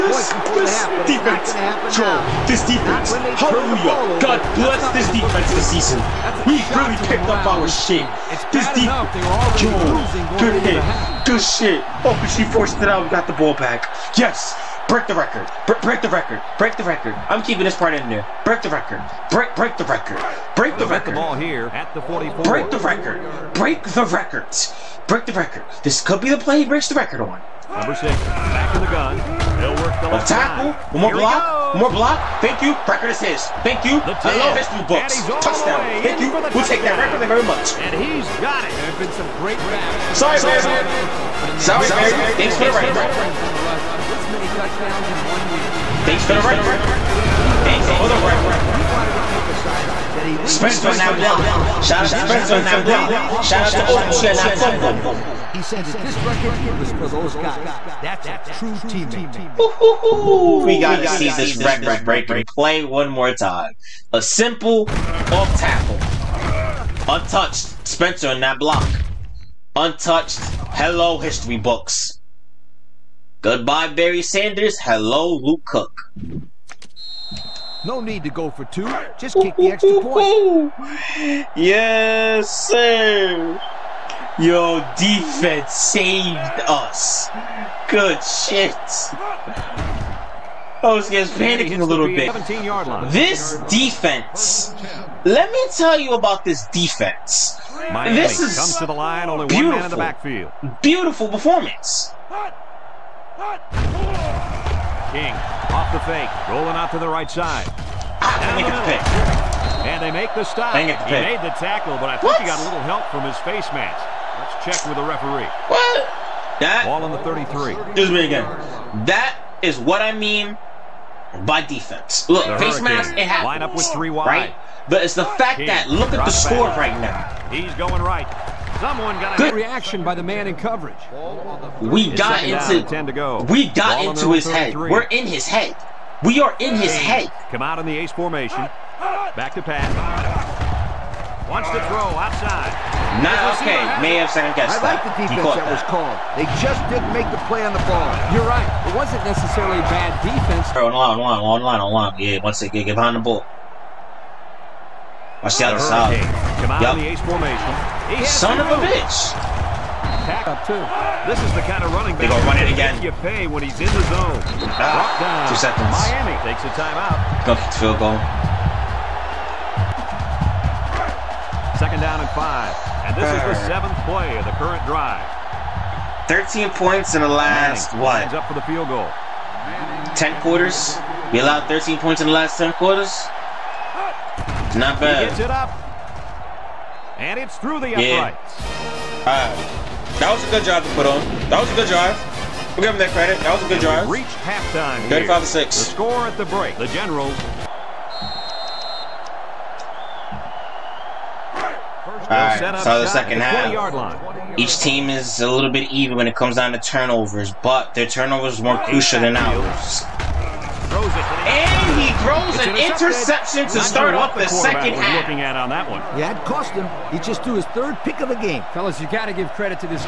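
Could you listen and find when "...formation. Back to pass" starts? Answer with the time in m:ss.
2:18.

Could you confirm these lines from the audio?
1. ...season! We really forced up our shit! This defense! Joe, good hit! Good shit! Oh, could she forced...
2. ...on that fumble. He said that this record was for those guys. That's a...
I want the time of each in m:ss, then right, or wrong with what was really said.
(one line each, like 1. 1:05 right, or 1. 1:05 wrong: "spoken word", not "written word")
1. 0:05 wrong: "picked", not "forced"
2. 0:54 right.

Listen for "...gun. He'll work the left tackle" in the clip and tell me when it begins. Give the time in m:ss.
0:28.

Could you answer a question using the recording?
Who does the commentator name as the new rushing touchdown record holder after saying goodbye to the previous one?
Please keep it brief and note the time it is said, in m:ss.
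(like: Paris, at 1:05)
Luke Cook, at 1:15.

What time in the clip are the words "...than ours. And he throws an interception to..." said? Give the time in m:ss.
3:29.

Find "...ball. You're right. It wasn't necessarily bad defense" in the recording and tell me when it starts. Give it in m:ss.
2:27.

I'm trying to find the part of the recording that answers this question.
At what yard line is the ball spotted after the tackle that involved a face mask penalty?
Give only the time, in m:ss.
1:57.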